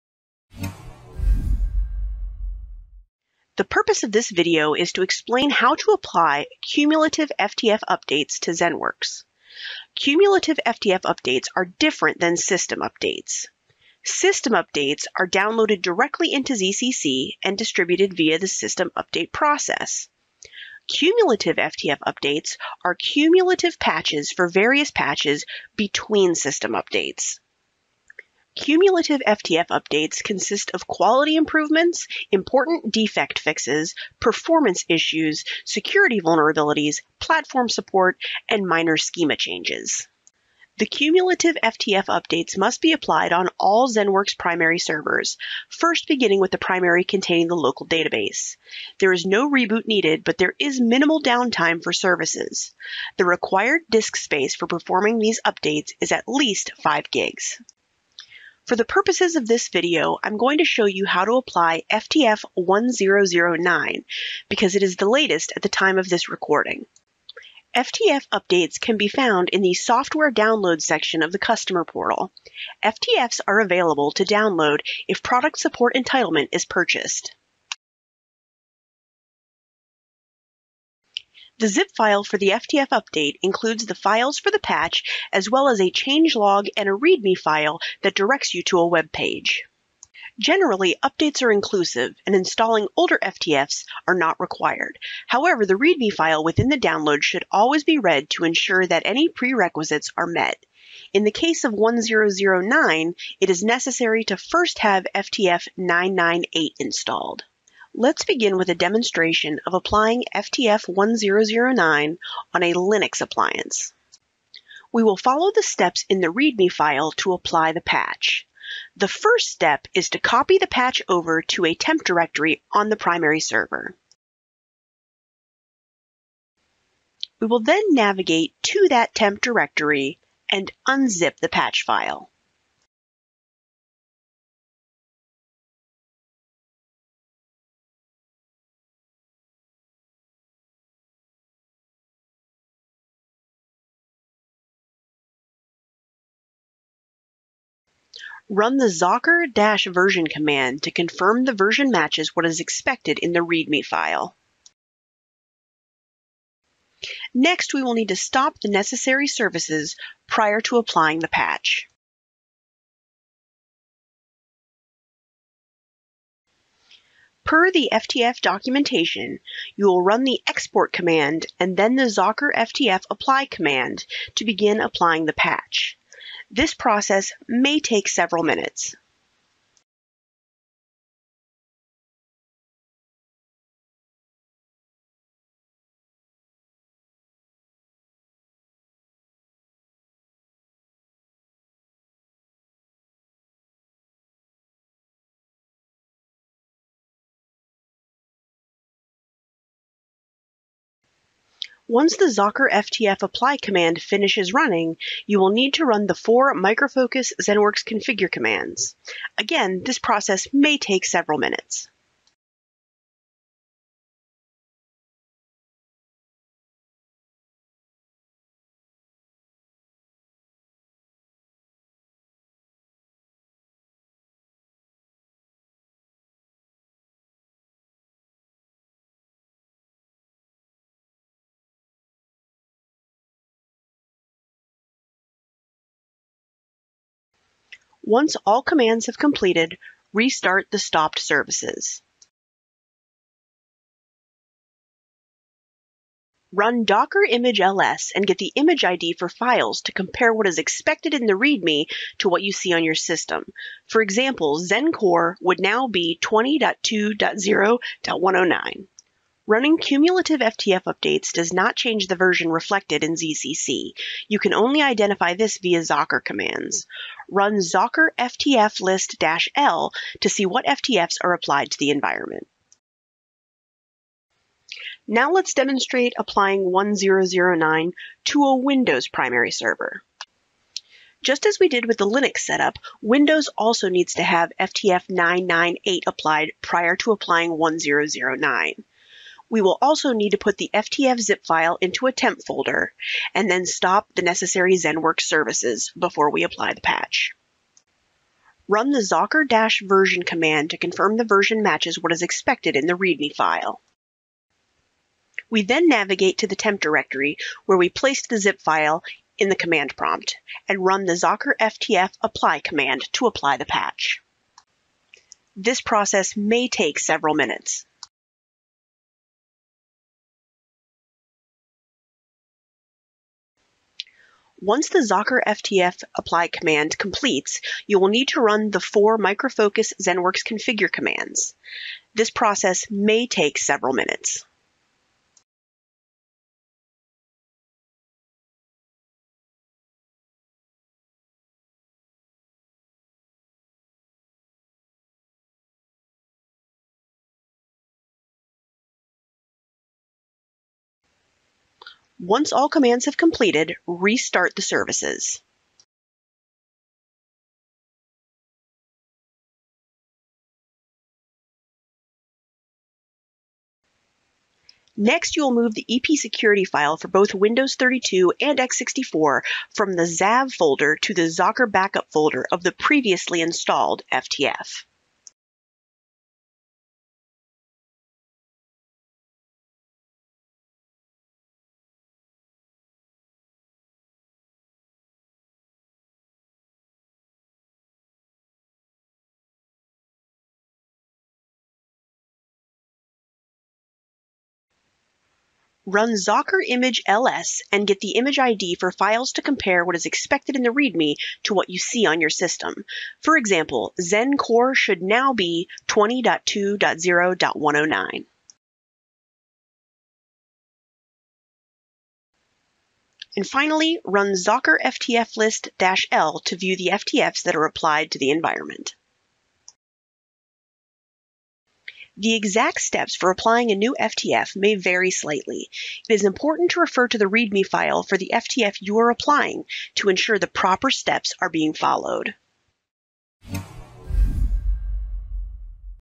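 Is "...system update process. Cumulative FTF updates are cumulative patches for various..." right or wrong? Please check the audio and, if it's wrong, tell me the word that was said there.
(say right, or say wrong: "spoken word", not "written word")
right.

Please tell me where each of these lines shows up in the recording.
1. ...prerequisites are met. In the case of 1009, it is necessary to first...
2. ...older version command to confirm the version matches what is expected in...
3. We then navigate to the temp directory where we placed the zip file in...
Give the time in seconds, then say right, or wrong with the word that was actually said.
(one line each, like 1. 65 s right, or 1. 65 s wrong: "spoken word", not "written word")
1. 99 s right
2. 148 s wrong: "zocker", not "older"
3. 305 s right.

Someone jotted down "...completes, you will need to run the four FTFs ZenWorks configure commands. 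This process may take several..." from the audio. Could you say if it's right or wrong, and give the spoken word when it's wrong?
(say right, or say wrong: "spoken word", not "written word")
wrong: "Microfocus", not "FTFs".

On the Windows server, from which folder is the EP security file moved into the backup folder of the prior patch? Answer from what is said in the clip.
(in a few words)
ZAV folder.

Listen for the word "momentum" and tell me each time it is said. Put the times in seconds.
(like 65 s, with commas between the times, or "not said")
not said.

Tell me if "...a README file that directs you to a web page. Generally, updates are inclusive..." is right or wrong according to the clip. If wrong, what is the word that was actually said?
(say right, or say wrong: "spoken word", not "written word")
right.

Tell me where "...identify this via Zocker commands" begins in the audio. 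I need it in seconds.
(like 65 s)
264 s.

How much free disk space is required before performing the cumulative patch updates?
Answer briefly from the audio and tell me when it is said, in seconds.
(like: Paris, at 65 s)
5 gigs, at 56 s.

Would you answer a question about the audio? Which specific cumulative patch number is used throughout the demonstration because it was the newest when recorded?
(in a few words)
FTF 1009.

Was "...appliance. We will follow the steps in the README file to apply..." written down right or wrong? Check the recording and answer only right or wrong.
right.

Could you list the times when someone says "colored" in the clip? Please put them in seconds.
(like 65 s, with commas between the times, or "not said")
not said.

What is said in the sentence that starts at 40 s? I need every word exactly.
The cumulative FTF updates must be applied on all ZENworks primary servers, first beginning with the primary containing the local database.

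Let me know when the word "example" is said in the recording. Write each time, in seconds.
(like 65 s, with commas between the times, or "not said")
254 s, 403 s.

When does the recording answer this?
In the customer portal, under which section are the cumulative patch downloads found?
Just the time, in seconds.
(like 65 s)
69 s.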